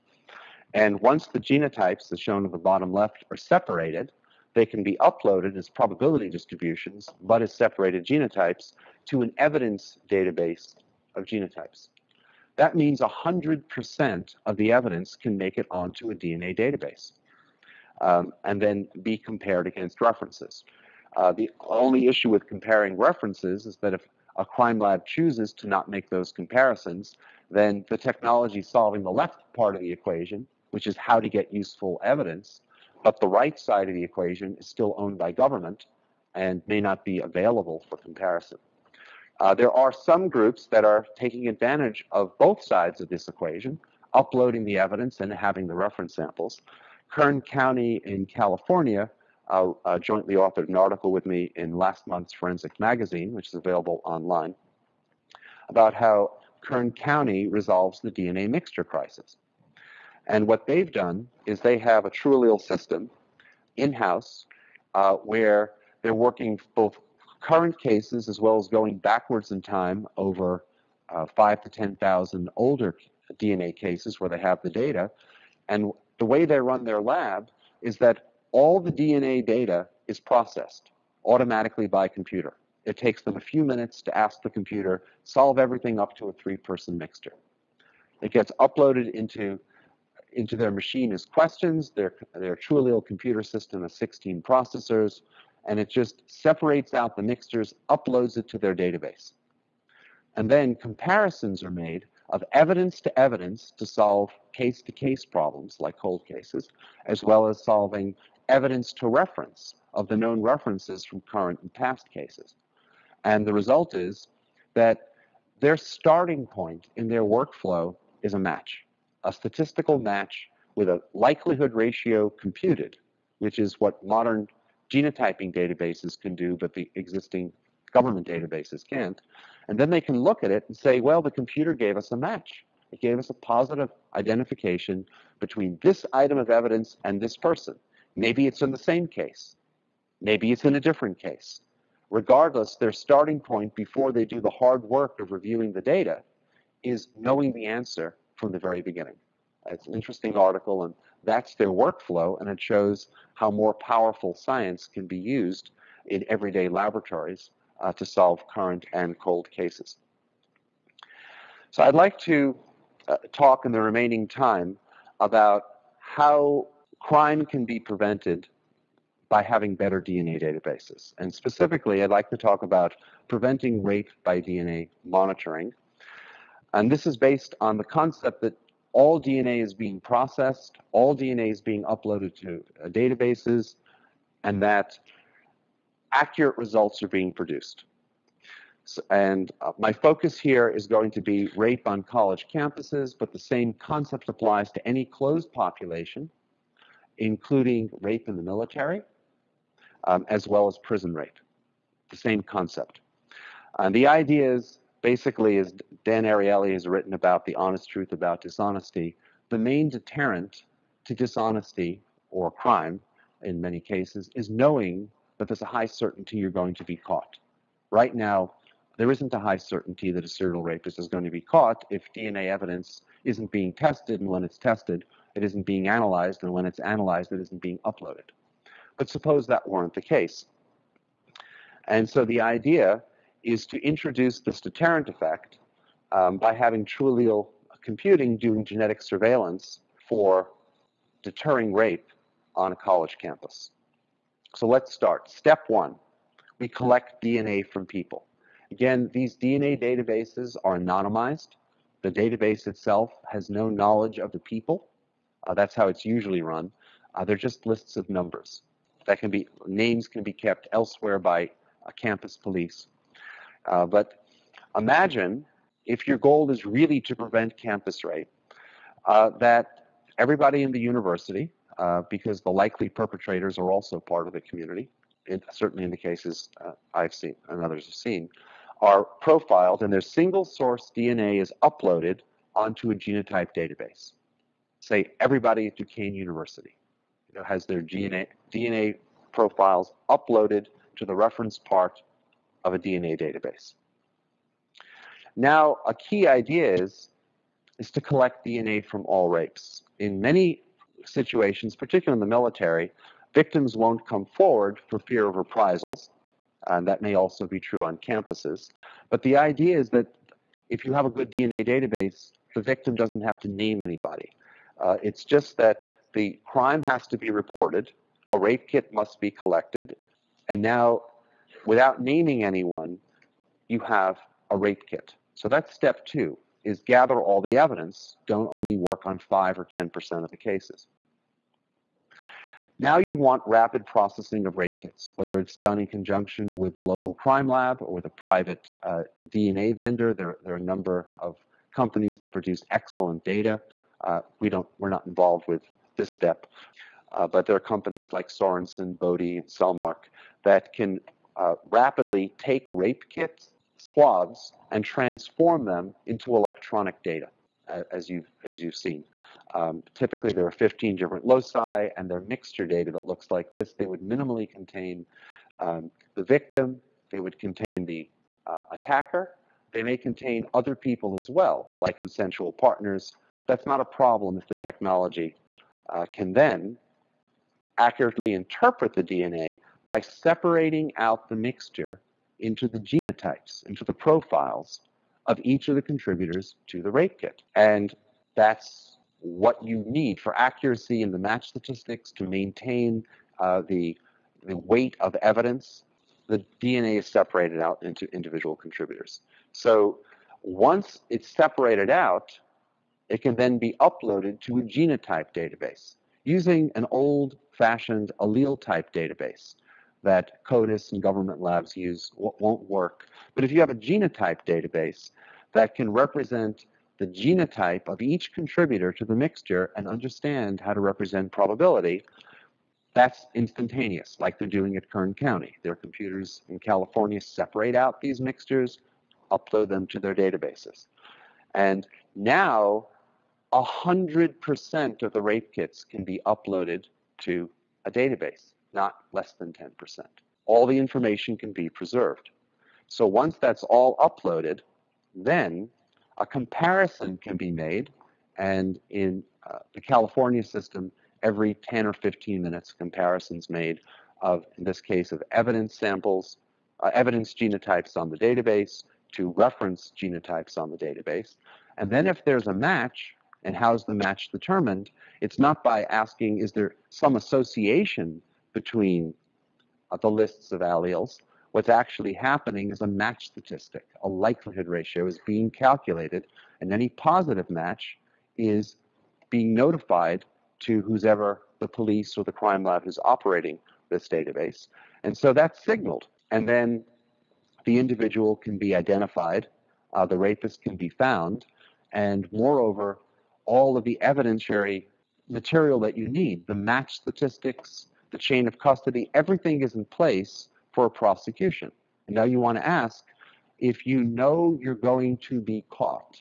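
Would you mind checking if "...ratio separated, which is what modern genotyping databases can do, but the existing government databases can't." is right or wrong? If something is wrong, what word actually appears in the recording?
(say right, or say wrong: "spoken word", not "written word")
wrong: "computed", not "separated".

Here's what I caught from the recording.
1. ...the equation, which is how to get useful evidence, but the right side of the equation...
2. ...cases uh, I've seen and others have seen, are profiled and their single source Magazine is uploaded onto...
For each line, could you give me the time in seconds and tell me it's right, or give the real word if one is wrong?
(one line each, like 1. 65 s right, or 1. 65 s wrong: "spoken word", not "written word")
1. 29 s right
2. 276 s wrong: "DNA", not "Magazine".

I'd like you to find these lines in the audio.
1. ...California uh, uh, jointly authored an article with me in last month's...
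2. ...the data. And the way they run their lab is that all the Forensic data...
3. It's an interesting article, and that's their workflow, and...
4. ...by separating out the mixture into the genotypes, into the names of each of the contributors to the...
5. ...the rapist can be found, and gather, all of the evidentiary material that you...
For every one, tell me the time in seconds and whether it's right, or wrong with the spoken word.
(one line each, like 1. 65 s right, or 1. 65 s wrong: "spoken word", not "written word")
1. 48 s right
2. 74 s wrong: "DNA", not "Forensic"
3. 149 s right
4. 379 s wrong: "profiles", not "names"
5. 490 s wrong: "moreover", not "gather".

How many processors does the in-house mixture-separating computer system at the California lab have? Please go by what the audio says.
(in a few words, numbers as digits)
16.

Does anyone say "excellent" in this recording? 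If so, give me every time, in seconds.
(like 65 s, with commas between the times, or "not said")
342 s.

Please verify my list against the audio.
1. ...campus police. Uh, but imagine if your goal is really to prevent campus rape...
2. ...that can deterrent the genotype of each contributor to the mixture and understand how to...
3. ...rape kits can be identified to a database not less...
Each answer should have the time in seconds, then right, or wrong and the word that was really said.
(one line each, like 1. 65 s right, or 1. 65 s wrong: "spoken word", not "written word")
1. 261 s right
2. 415 s wrong: "represent", not "deterrent"
3. 435 s wrong: "uploaded", not "identified".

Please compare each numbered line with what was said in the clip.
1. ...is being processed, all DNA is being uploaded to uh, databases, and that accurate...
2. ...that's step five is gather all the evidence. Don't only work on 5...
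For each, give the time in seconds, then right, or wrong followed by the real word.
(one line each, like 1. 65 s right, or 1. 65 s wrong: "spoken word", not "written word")
1. 179 s right
2. 325 s wrong: "two", not "five".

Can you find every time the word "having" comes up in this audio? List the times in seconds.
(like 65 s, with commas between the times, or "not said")
45 s, 169 s, 236 s.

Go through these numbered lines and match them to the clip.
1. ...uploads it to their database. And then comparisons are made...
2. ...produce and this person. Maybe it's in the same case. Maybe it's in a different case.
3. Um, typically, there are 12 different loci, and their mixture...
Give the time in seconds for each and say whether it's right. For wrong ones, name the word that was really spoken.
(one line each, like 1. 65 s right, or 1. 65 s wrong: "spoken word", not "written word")
1. 97 s right
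2. 136 s wrong: "evidence", not "produce"
3. 359 s wrong: "15", not "12".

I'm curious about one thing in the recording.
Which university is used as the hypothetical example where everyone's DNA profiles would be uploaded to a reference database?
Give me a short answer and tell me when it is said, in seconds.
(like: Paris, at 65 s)
Duquesne University, at 285 s.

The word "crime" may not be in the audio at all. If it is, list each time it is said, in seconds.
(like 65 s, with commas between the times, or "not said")
24 s, 166 s, 212 s, 316 s, 337 s, 482 s.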